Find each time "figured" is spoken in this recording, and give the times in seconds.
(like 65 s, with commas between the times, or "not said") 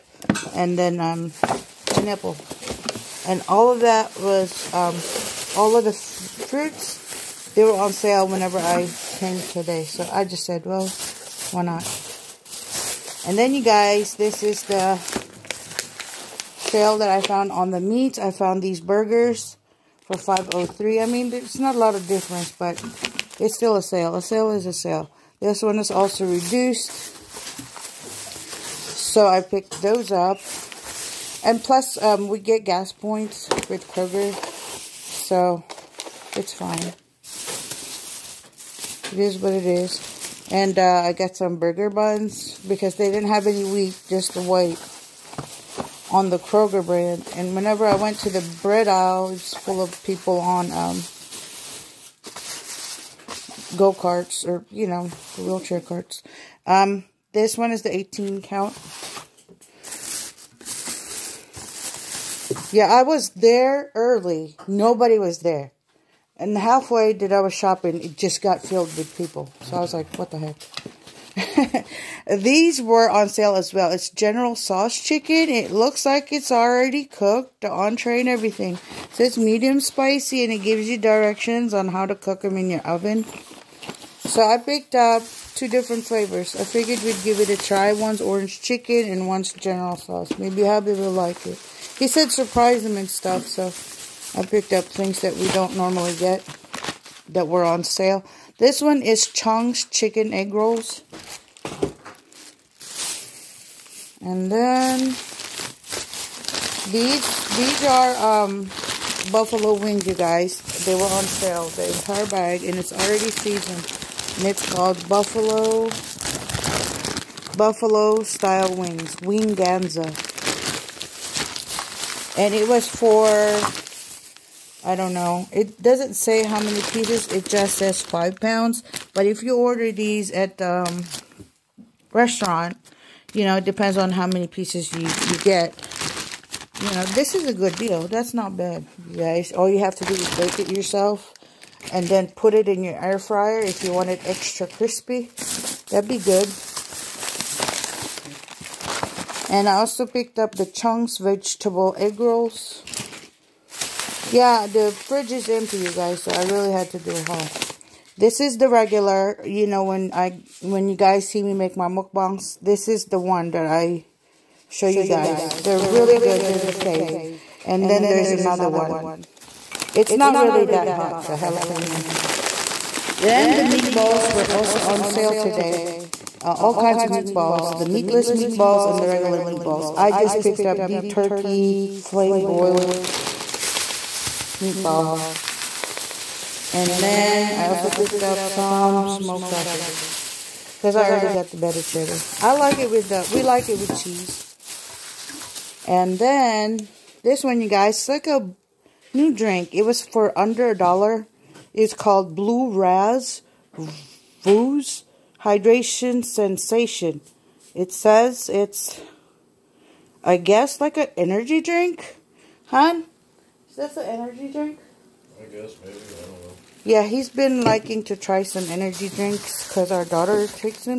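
86 s.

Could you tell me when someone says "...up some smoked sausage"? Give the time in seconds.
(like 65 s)
188 s.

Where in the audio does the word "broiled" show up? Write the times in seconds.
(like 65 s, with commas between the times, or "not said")
182 s.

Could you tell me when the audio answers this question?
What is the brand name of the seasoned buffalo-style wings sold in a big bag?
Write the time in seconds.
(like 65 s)
119 s.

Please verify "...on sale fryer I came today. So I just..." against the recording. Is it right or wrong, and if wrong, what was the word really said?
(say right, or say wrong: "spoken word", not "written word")
wrong: "whenever", not "fryer".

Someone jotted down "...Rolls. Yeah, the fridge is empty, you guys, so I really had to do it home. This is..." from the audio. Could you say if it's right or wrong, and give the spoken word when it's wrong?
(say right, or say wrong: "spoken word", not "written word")
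right.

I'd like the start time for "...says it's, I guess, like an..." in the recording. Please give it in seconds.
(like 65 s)
207 s.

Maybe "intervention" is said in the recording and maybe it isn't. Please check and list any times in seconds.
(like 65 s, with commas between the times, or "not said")
not said.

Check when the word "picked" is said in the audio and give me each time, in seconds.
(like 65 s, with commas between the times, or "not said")
29 s, 84 s, 94 s, 150 s, 180 s, 187 s.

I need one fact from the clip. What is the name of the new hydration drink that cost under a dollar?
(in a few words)
Blue Raz Vuz Hydration Sensation.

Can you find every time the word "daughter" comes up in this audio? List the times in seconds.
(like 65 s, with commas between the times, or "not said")
220 s.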